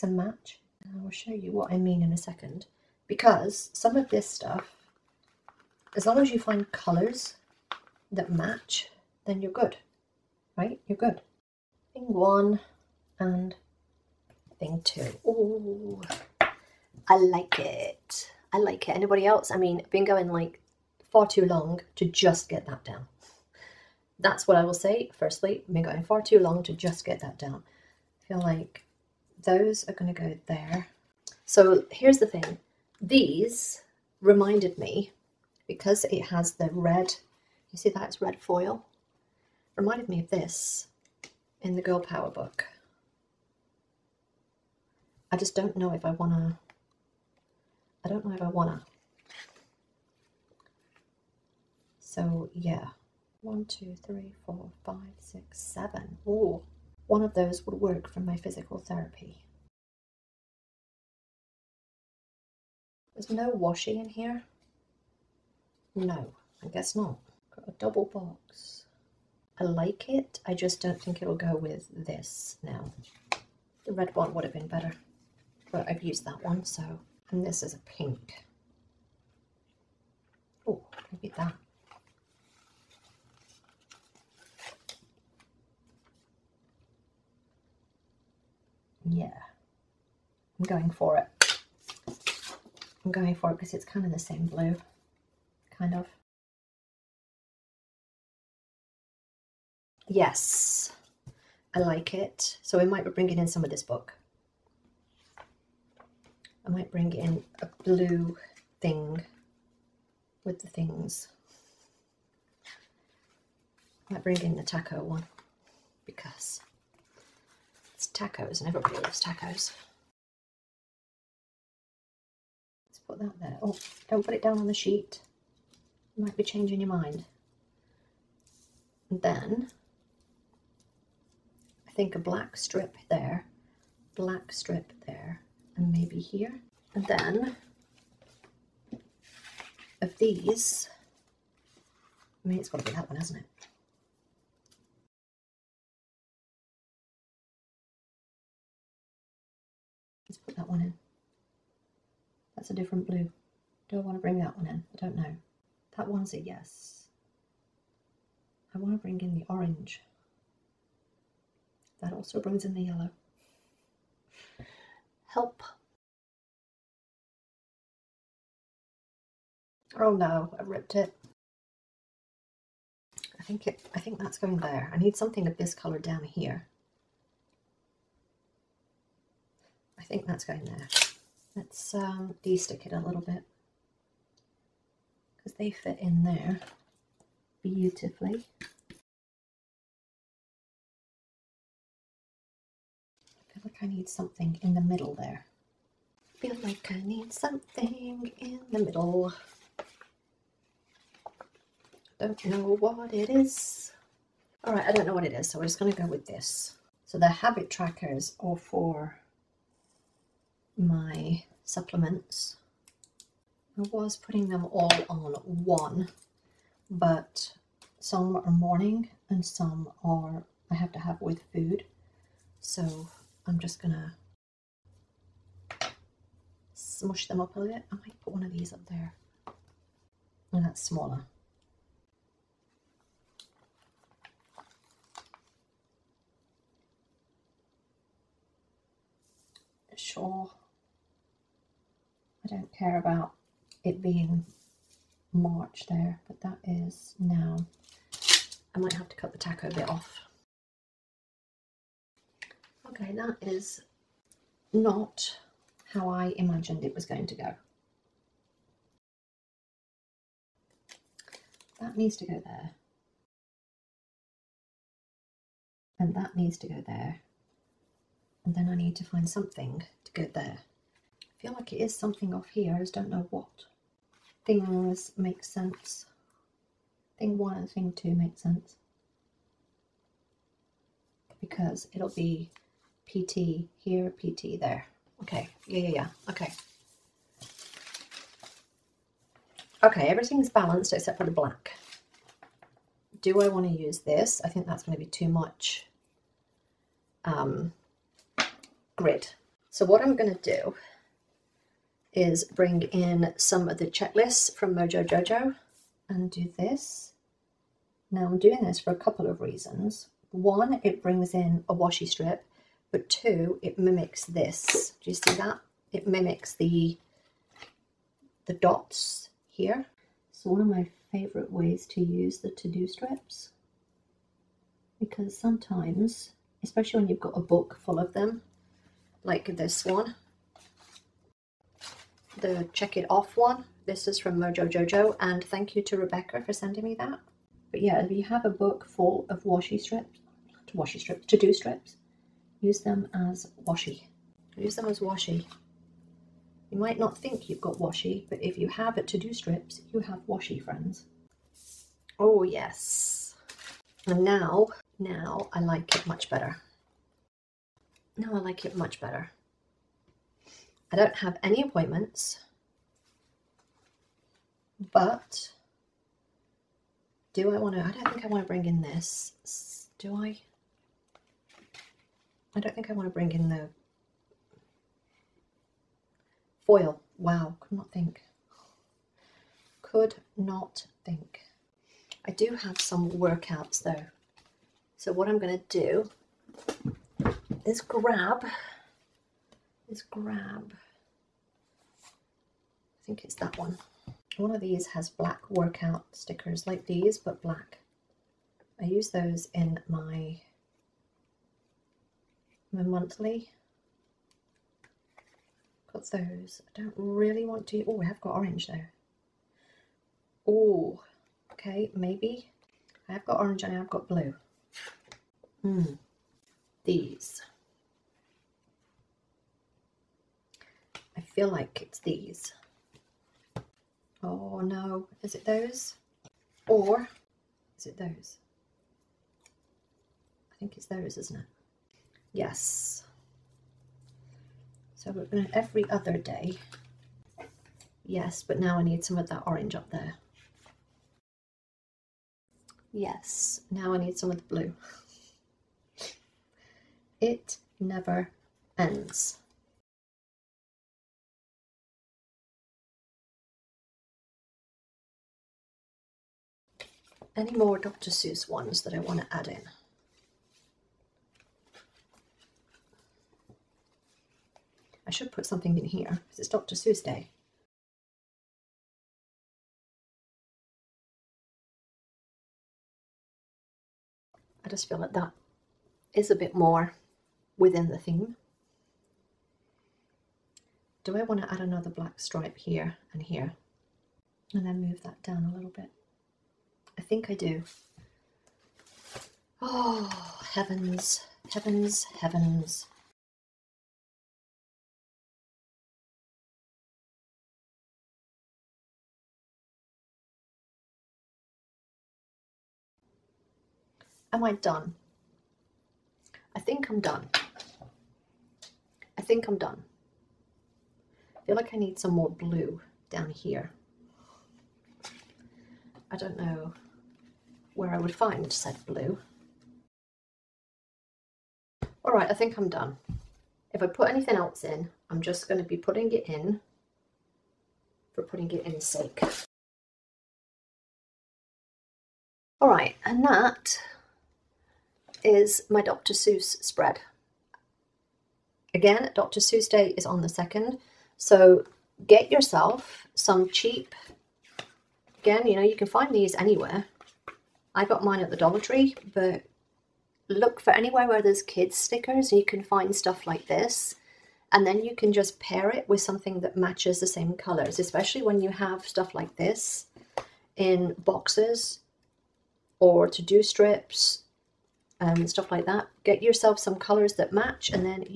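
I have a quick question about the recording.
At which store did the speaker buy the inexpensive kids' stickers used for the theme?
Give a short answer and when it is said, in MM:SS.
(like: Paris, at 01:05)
Dollar Tree, at 09:08.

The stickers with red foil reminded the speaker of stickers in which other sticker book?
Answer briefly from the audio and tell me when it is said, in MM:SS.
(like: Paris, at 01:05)
Girl Power, at 00:41.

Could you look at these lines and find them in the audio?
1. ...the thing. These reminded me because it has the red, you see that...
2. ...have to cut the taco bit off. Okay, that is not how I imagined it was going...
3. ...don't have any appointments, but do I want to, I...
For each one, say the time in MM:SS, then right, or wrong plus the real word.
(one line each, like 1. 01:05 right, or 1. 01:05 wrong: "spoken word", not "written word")
1. 00:32 right
2. 04:08 right
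3. 06:00 right.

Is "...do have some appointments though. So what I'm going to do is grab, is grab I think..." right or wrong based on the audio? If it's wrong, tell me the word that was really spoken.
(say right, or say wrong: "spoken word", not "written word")
wrong: "workouts", not "appointments".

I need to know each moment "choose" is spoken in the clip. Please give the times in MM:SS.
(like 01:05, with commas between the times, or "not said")
not said.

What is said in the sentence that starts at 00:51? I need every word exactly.
So yeah, one, two, three, four, five, six, seven.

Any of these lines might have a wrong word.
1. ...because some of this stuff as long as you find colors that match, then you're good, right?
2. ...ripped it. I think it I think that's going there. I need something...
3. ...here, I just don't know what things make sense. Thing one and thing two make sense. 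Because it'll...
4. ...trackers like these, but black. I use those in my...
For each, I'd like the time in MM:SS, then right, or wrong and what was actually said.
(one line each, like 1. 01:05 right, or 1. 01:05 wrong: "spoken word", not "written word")
1. 00:03 right
2. 02:50 right
3. 04:32 right
4. 06:36 wrong: "stickers", not "trackers".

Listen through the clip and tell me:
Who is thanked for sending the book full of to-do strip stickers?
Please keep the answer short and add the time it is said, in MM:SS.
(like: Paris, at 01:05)
Rebecca, at 05:35.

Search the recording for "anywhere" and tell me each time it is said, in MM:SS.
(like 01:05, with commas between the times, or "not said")
09:06, 09:10.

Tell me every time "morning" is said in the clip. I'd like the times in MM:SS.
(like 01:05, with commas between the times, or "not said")
03:38.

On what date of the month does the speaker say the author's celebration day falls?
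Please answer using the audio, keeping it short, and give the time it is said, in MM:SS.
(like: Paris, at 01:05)
2nd, at 09:00.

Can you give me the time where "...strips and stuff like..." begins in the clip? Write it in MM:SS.
09:23.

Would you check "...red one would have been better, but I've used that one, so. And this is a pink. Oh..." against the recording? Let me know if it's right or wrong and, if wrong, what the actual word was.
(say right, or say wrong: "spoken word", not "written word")
right.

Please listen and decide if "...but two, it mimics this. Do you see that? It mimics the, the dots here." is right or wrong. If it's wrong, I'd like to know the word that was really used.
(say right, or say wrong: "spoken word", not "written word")
right.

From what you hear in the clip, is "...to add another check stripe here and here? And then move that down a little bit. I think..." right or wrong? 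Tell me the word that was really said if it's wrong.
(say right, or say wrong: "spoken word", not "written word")
wrong: "black", not "check".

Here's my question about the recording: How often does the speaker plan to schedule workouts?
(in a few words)
Every other day.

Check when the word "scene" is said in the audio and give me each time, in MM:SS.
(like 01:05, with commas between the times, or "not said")
not said.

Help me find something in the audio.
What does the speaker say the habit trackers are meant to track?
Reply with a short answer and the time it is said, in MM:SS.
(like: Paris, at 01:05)
Supplements, at 03:31.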